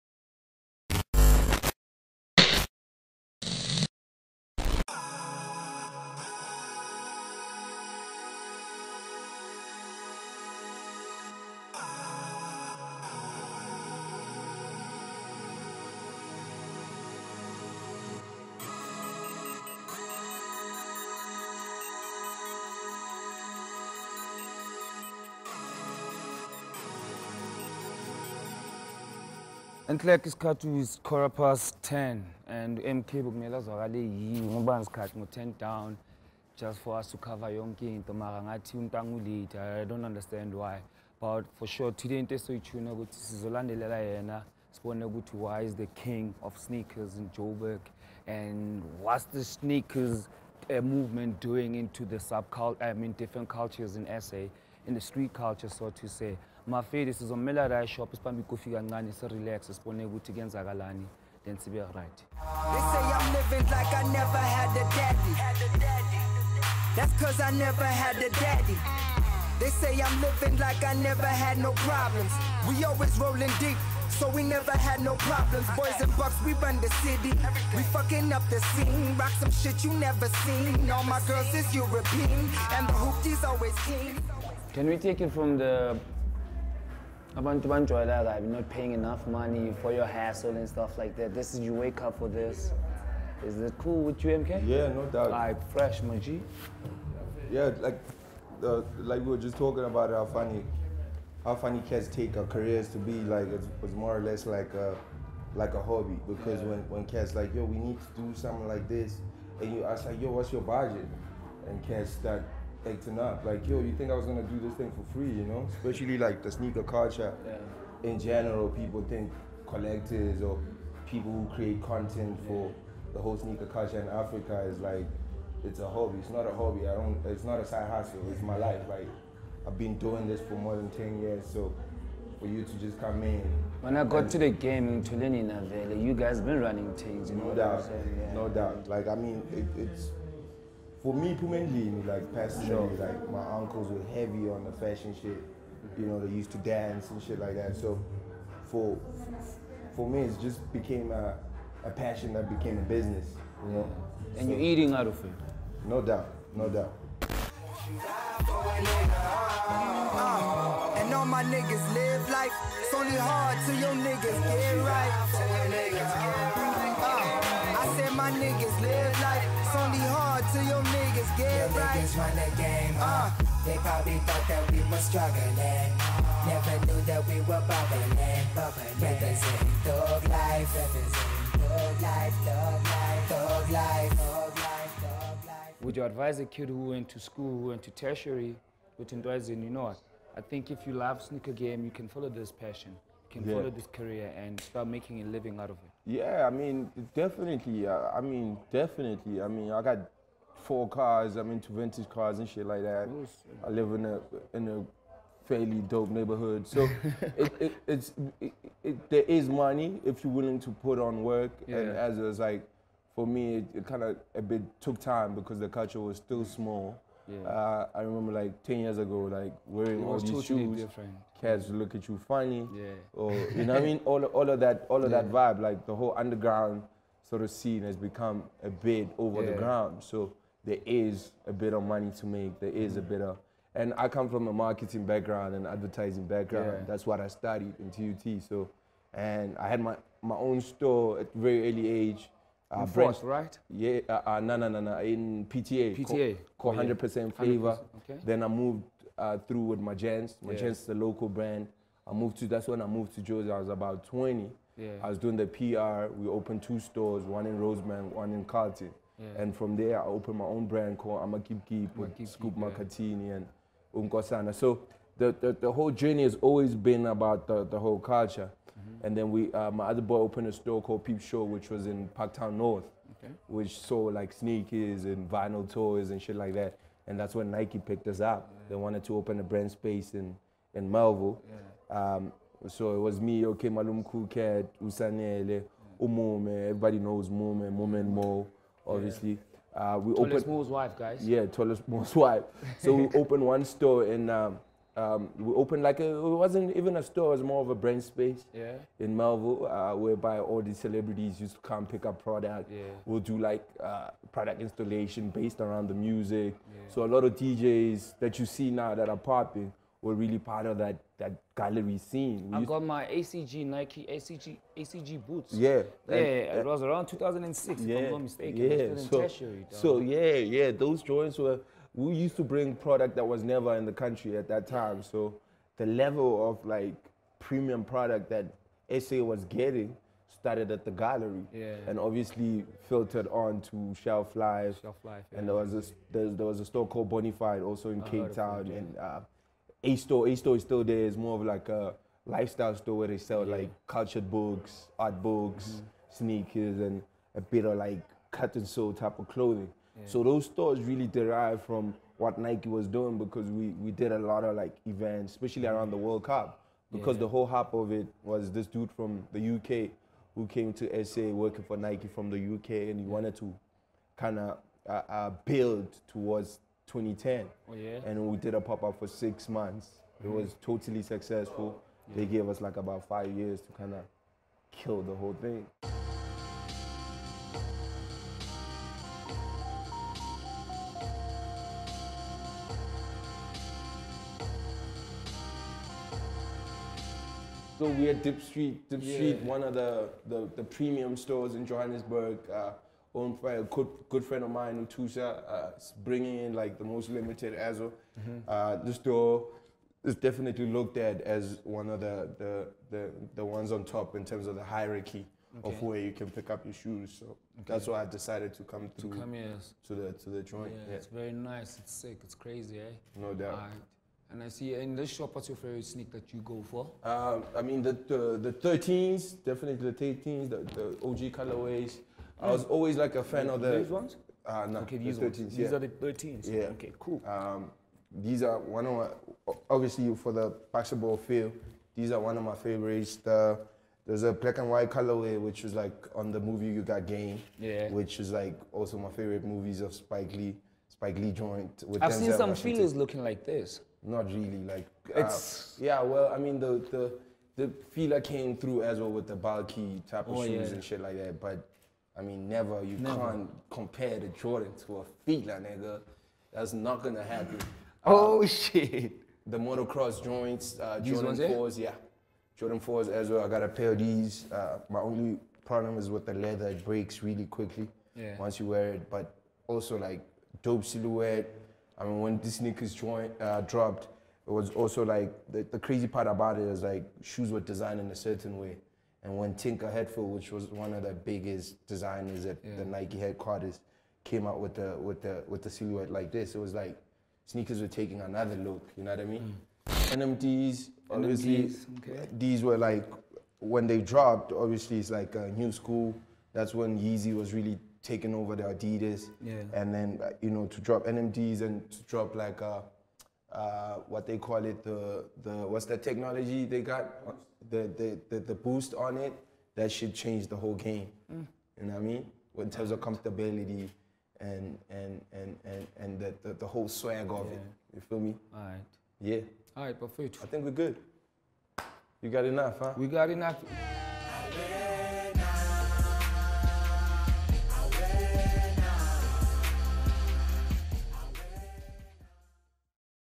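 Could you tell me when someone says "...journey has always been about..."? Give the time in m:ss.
4:25.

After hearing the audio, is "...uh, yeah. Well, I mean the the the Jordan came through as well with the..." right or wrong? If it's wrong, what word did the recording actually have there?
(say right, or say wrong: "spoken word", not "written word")
wrong: "Fila", not "Jordan".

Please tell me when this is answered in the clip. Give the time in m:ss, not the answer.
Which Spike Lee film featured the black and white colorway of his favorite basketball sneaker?
7:16.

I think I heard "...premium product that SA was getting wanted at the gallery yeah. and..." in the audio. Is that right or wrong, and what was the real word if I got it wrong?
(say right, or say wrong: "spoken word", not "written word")
wrong: "started", not "wanted".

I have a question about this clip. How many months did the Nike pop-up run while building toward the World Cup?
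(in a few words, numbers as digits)
6.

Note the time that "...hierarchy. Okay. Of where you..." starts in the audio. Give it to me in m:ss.
6:44.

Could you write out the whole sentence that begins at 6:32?
Uh, owned by a good, good friend of mine, Utusha, uh, bringing in like the most limited Azo.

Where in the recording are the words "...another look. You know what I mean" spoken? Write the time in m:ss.
8:08.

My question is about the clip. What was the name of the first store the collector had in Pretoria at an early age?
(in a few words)
100% Flavor.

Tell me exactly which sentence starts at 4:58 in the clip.
in Melville, uh, whereby all the celebrities used to come pick up product.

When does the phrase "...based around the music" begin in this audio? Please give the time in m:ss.
5:05.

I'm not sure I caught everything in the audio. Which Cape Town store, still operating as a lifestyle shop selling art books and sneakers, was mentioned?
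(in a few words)
Bonifide.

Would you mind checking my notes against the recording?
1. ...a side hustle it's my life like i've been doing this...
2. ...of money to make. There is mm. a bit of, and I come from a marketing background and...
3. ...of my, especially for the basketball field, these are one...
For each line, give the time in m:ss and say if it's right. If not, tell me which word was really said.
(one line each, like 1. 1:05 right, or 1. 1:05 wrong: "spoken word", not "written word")
1. 2:07 right
2. 3:51 right
3. 7:08 wrong: "obviously", not "especially".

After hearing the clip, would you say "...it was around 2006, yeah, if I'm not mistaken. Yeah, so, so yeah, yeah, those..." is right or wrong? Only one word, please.
right.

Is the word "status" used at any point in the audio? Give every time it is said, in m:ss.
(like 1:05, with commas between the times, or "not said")
not said.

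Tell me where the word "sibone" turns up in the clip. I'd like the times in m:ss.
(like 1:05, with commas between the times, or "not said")
0:44, 0:59.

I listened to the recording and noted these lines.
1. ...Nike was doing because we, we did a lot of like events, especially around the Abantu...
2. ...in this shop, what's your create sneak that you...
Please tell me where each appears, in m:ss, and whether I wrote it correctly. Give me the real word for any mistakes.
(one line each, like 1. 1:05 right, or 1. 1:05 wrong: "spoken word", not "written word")
1. 5:52 wrong: "World", not "Abantu"
2. 6:54 wrong: "favorite", not "create".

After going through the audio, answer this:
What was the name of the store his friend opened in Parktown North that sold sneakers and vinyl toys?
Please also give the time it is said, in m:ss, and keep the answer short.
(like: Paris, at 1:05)
Peep Show, at 4:31.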